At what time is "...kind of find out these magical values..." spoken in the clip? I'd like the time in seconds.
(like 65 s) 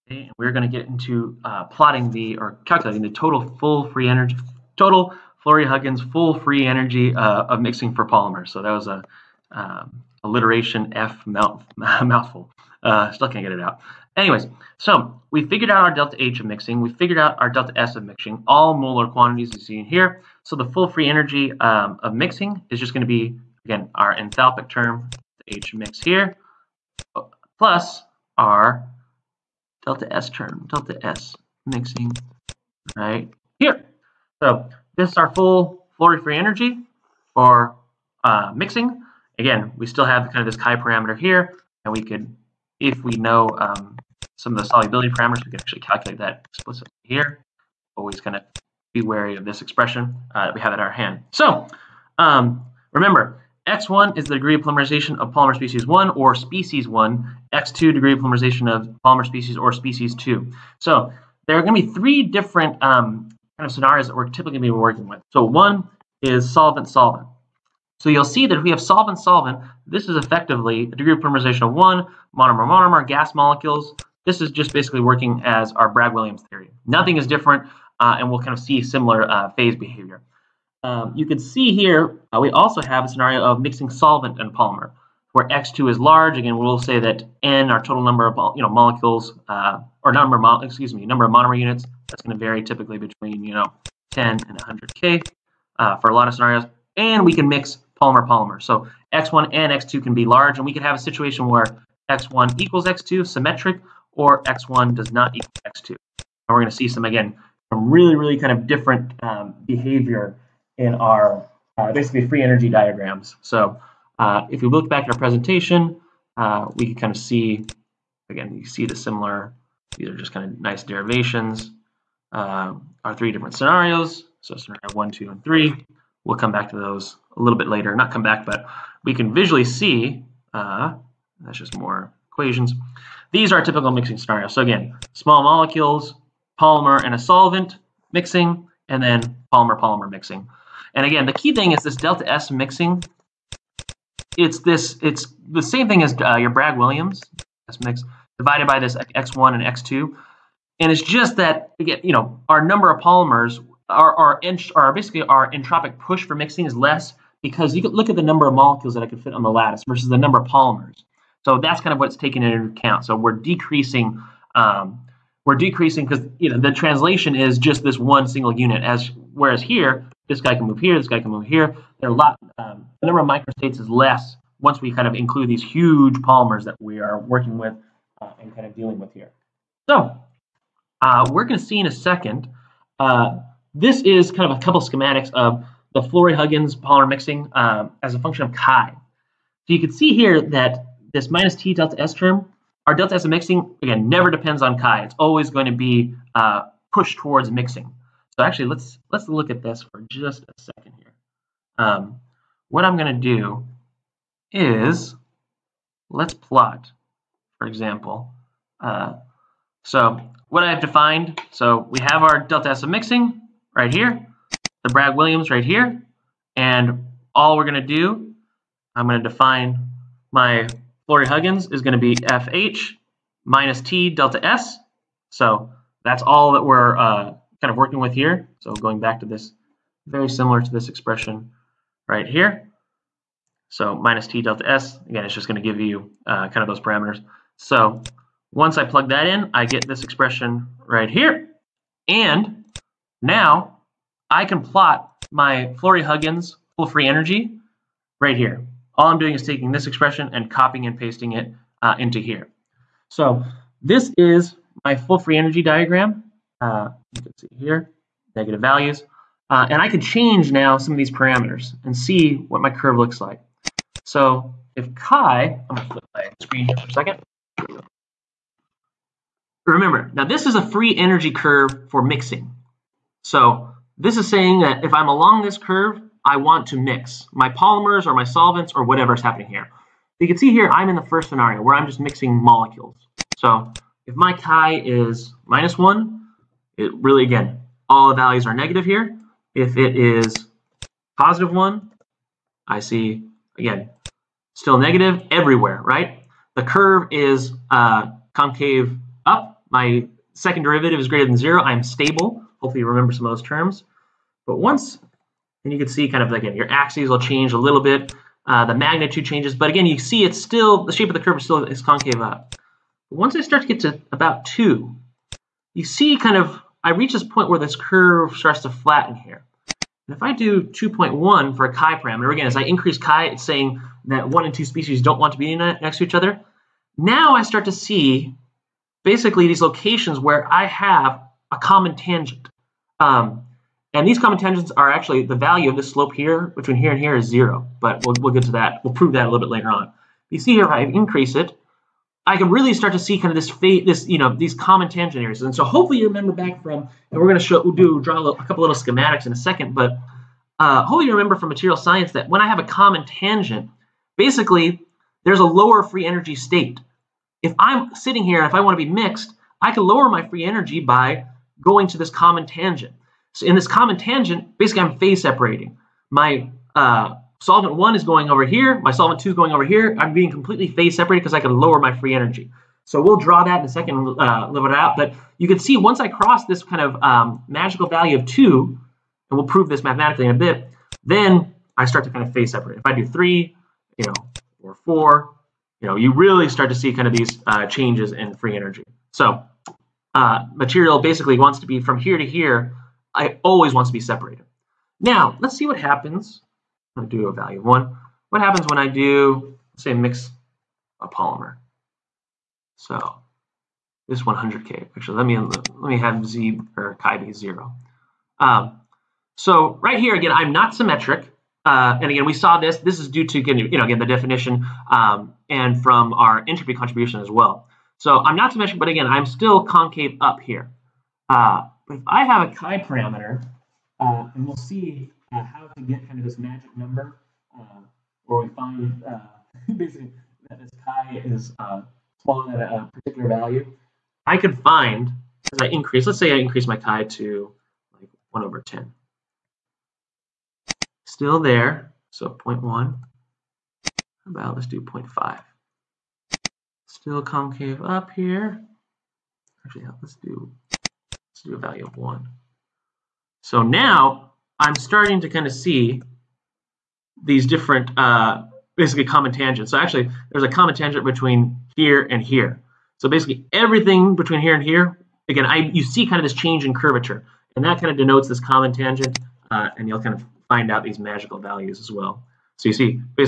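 470 s.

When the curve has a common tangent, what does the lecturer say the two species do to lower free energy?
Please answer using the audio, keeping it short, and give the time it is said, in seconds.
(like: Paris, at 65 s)
phase separating, at 364 s.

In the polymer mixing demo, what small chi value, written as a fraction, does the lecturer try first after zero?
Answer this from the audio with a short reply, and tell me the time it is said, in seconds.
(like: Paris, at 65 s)
1/10, at 438 s.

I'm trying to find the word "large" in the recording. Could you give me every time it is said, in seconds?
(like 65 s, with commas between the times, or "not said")
85 s, 100 s.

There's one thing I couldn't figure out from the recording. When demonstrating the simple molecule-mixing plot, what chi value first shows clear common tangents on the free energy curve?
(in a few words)
2.1.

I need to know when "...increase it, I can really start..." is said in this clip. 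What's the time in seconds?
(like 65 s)
340 s.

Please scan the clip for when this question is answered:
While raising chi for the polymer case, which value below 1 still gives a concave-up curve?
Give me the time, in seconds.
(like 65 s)
444 s.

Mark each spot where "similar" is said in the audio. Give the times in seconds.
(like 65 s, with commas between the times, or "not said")
78 s, 118 s, 230 s.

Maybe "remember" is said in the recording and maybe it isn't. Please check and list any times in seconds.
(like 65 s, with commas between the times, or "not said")
52 s, 269 s, 302 s, 346 s, 351 s.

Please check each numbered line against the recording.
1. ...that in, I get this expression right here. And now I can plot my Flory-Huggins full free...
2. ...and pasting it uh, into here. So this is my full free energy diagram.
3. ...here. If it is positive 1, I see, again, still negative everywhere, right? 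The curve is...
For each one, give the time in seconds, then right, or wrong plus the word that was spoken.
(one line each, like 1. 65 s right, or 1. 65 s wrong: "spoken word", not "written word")
1. 239 s right
2. 250 s right
3. 288 s right.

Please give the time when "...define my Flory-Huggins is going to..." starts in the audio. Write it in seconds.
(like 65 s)
219 s.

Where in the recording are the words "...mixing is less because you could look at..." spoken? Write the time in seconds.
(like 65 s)
156 s.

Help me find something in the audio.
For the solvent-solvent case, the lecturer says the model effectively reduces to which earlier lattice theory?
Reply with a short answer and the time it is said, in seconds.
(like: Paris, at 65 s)
Bragg-Williams theory, at 75 s.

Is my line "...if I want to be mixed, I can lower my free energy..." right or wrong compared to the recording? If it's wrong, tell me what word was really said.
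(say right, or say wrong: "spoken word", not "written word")
right.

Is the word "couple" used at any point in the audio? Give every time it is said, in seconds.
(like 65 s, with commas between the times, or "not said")
184 s, 348 s.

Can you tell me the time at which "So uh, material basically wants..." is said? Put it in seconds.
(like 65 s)
389 s.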